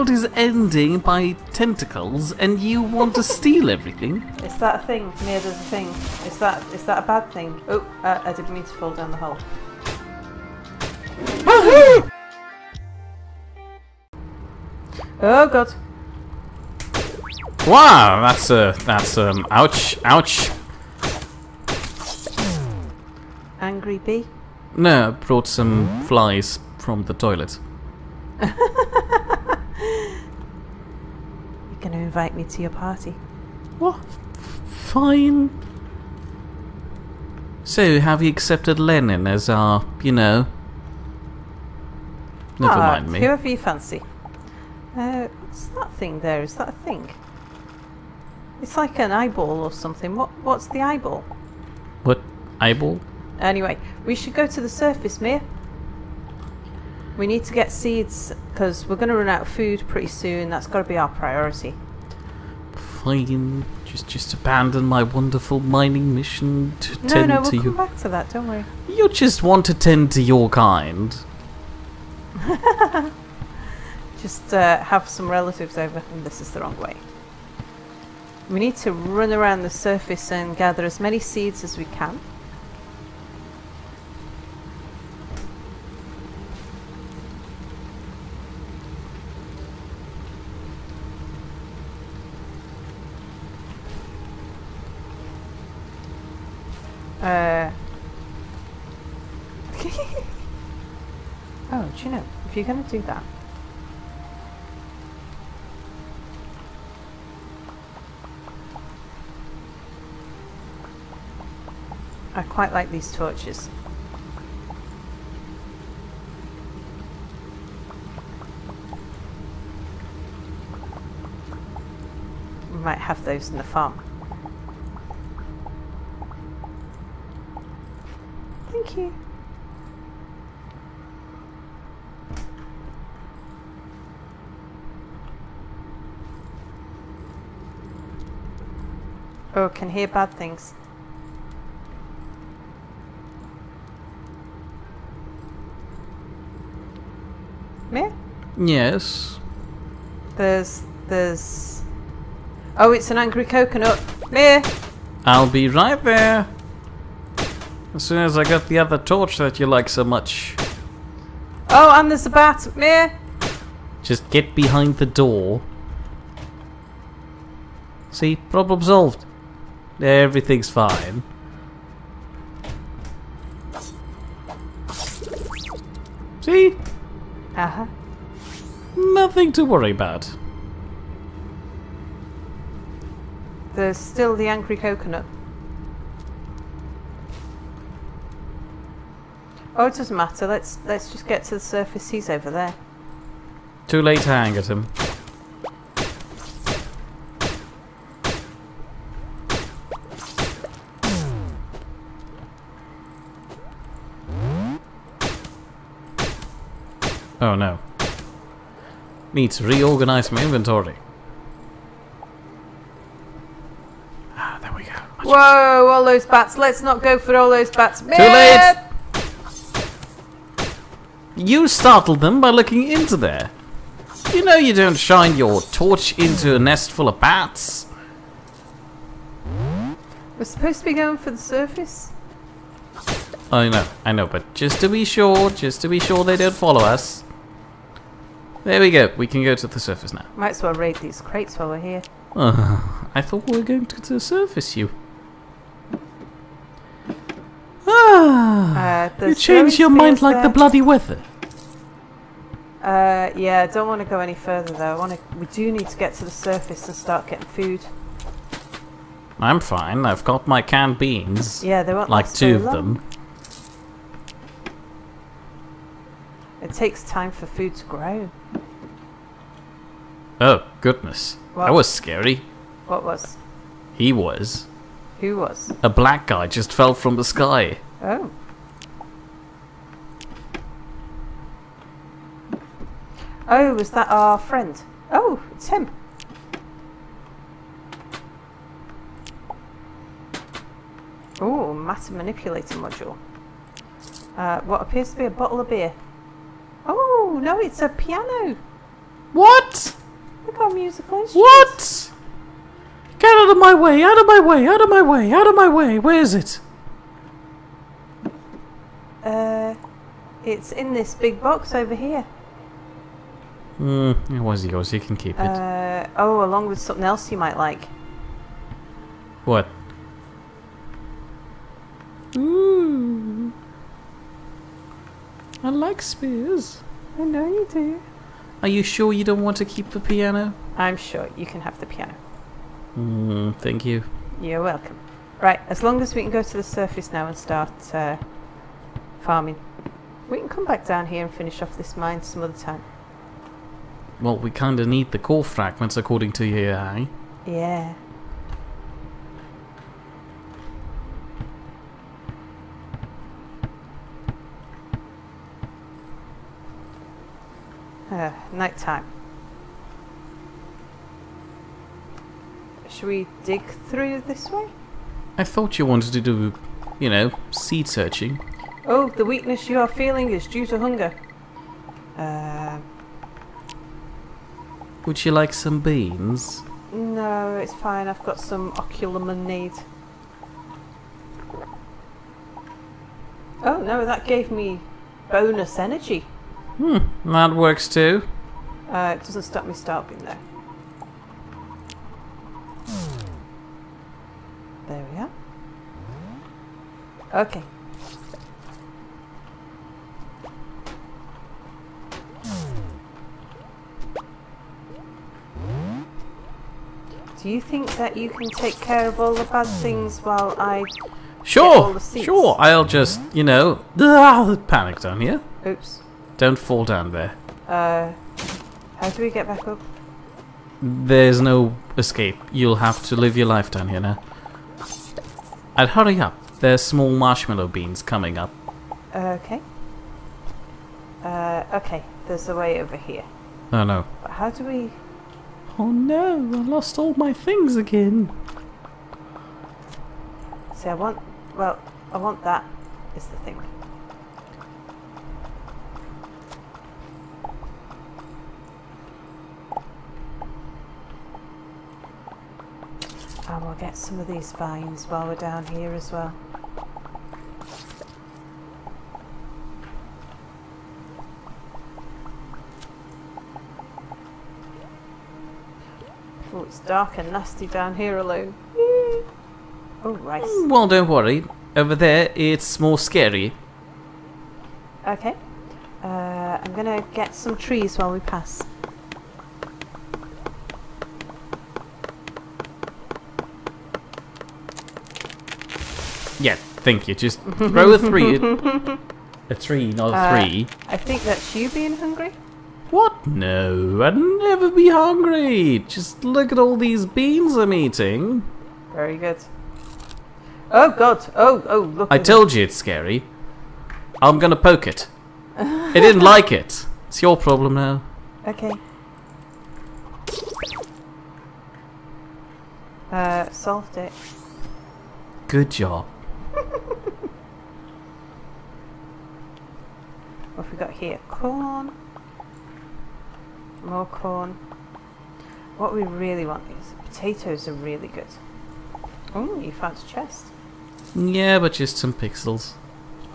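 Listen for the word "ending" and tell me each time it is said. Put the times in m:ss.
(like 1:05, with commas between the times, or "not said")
0:00.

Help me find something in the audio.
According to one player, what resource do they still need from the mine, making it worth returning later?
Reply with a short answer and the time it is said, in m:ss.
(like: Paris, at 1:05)
core fragments, at 5:45.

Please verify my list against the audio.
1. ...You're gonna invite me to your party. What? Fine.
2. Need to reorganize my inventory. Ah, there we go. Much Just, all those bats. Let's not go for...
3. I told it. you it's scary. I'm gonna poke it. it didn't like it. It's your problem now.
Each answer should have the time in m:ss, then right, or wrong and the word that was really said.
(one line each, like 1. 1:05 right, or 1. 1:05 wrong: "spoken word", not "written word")
1. 0:28 right
2. 3:29 wrong: "Whoa", not "Just"
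3. 8:22 right.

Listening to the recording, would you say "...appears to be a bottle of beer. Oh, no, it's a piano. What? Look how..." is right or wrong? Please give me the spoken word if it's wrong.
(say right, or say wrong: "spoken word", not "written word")
right.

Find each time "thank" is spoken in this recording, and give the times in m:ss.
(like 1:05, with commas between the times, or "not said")
2:08, 5:33.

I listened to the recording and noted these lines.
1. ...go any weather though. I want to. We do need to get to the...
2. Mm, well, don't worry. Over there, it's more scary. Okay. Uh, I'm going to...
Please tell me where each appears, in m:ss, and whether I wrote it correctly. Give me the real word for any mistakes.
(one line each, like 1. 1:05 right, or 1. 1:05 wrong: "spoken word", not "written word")
1. 4:14 wrong: "further", not "weather"
2. 7:50 right.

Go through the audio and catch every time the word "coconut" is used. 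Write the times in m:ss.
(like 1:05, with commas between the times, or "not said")
2:33, 3:04.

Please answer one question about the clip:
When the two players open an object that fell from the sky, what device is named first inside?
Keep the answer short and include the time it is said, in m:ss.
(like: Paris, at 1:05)
matter manipulator module, at 4:51.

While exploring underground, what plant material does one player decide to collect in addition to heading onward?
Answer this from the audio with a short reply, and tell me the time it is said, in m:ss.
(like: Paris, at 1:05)
vines, at 7:34.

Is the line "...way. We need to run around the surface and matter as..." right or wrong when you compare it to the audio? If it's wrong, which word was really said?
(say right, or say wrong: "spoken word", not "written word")
wrong: "gather", not "matter".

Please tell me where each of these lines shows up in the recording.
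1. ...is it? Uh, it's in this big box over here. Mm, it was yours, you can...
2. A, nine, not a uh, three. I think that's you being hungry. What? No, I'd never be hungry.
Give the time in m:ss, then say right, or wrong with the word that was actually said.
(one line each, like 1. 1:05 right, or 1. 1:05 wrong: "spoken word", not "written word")
1. 5:06 right
2. 8:09 wrong: "three", not "nine".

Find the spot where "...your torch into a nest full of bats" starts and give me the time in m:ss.
3:45.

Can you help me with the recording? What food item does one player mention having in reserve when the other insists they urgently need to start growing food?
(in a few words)
canned beans.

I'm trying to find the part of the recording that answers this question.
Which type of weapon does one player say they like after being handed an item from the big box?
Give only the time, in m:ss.
5:26.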